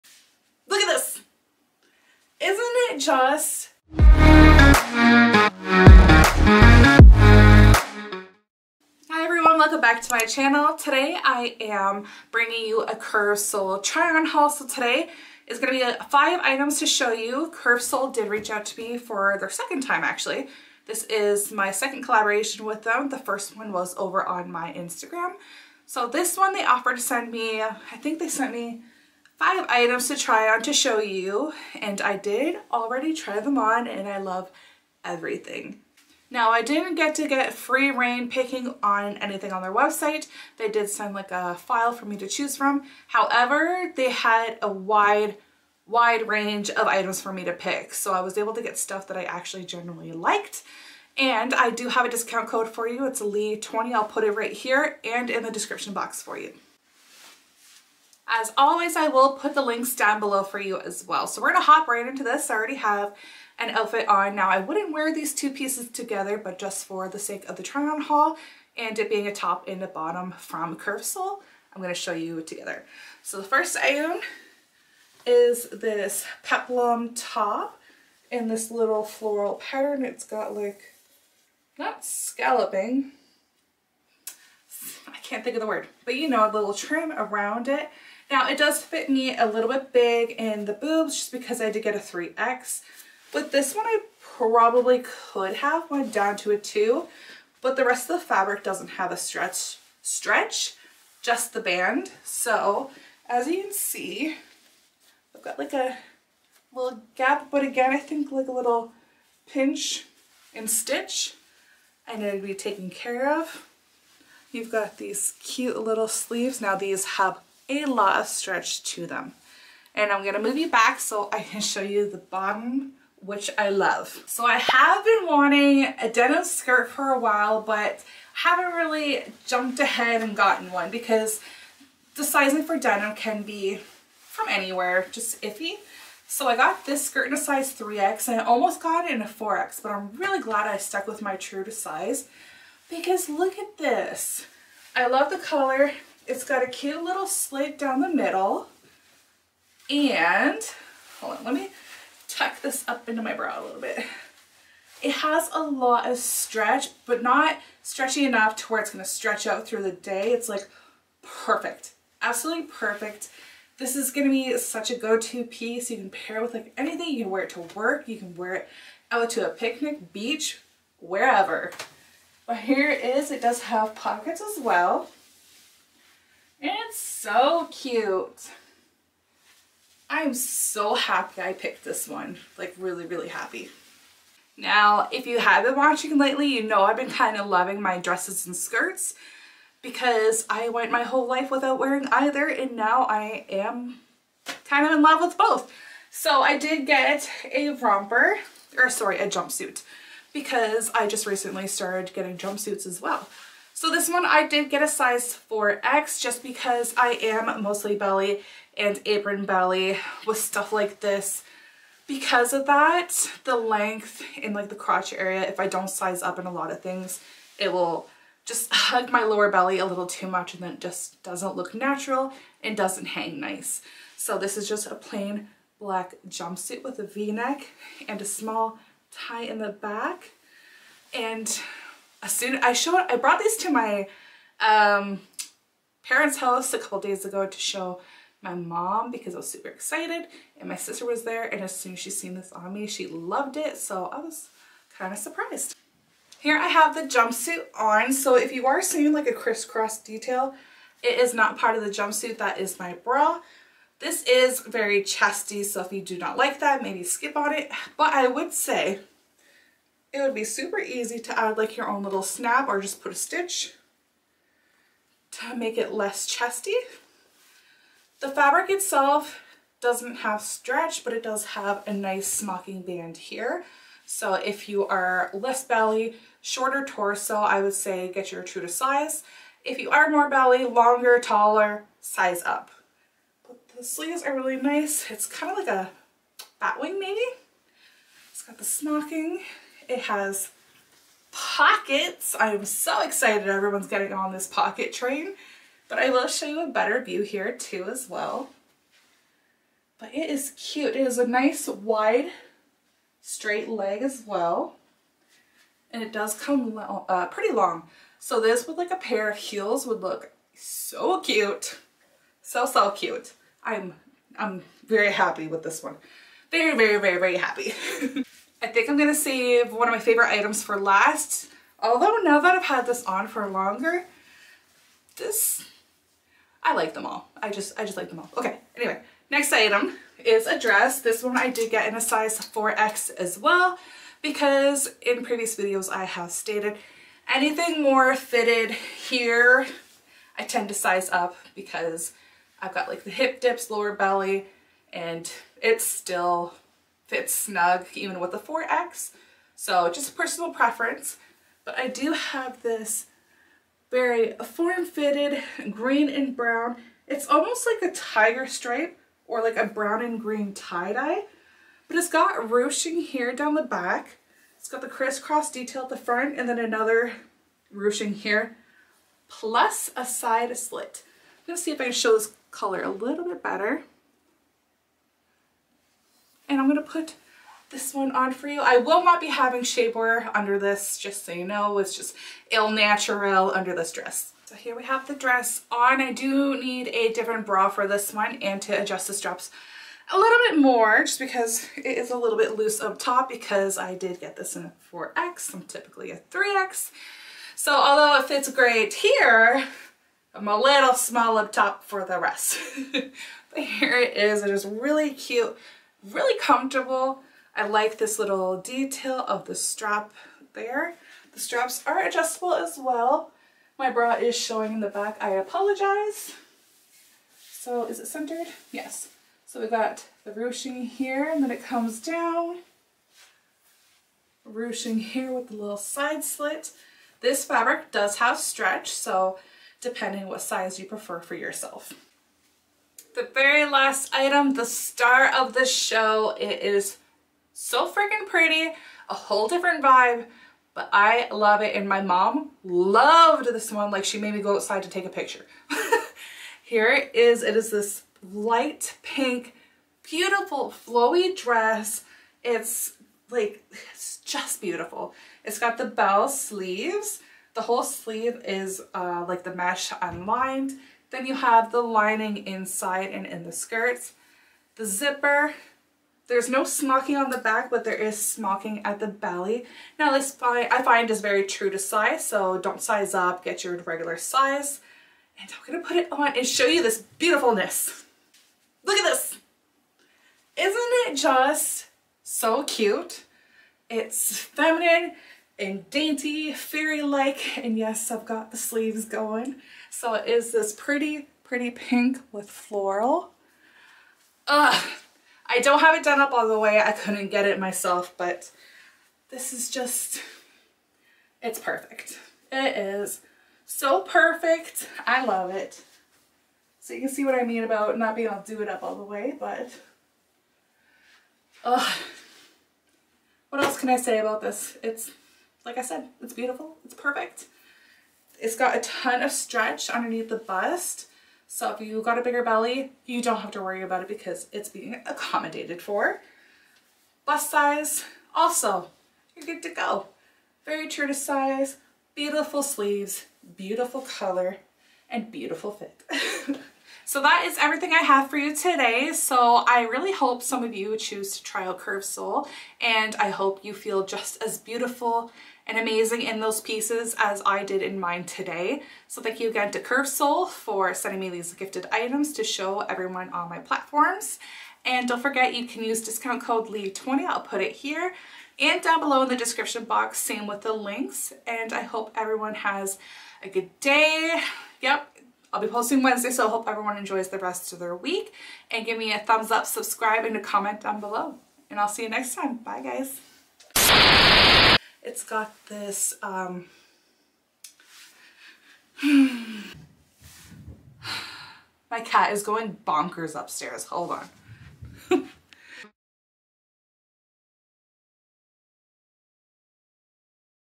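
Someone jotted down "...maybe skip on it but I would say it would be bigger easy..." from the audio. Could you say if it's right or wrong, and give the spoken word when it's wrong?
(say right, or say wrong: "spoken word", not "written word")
wrong: "super", not "bigger".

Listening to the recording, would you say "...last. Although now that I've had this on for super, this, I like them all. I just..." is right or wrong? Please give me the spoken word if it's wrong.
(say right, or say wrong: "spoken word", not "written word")
wrong: "longer", not "super".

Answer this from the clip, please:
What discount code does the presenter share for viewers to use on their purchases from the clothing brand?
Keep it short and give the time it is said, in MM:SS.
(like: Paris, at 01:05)
Leigh20, at 00:53.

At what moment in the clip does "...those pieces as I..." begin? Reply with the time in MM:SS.
09:06.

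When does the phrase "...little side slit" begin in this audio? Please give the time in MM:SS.
07:05.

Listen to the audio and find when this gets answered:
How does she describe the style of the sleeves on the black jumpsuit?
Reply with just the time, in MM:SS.
04:46.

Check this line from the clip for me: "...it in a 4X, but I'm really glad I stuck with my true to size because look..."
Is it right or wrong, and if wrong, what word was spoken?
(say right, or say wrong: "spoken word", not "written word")
right.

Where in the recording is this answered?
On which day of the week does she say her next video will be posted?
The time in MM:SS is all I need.
09:26.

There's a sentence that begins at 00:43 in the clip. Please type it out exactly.
However, they had a wide, wide range of items for me to pick.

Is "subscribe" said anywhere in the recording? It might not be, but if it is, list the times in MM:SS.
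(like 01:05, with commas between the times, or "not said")
09:29.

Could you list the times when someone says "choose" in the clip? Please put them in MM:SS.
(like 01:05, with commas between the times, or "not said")
00:42, 09:00.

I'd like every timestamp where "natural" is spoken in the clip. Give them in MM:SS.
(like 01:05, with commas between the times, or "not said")
03:41, 06:22.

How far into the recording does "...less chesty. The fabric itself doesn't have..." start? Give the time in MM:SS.
04:25.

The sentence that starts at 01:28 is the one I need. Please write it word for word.
Now it does fit me a little bit big in the boobs just because I did get a 3X.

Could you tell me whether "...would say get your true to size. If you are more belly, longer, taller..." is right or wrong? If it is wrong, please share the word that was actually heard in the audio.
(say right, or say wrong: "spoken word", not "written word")
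right.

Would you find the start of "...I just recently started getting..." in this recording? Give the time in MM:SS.
03:20.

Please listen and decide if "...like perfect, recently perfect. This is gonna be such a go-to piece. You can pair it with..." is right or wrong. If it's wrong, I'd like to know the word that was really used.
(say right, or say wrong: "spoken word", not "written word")
wrong: "absolutely", not "recently".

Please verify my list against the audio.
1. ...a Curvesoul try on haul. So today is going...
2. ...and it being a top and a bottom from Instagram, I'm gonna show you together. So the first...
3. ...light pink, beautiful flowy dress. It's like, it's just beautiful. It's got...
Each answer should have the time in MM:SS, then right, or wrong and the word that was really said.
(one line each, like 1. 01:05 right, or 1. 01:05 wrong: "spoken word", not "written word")
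1. 00:12 right
2. 01:08 wrong: "Curvesoul", not "Instagram"
3. 07:28 right.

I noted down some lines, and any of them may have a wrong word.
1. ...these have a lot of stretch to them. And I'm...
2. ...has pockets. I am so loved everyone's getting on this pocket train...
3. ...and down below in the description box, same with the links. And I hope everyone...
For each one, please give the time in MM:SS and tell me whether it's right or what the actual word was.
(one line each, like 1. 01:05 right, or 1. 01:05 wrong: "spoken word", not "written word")
1. 01:56 right
2. 04:50 wrong: "excited", not "loved"
3. 09:18 right.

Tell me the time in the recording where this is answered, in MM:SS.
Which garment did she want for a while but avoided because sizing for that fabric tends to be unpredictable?
02:06.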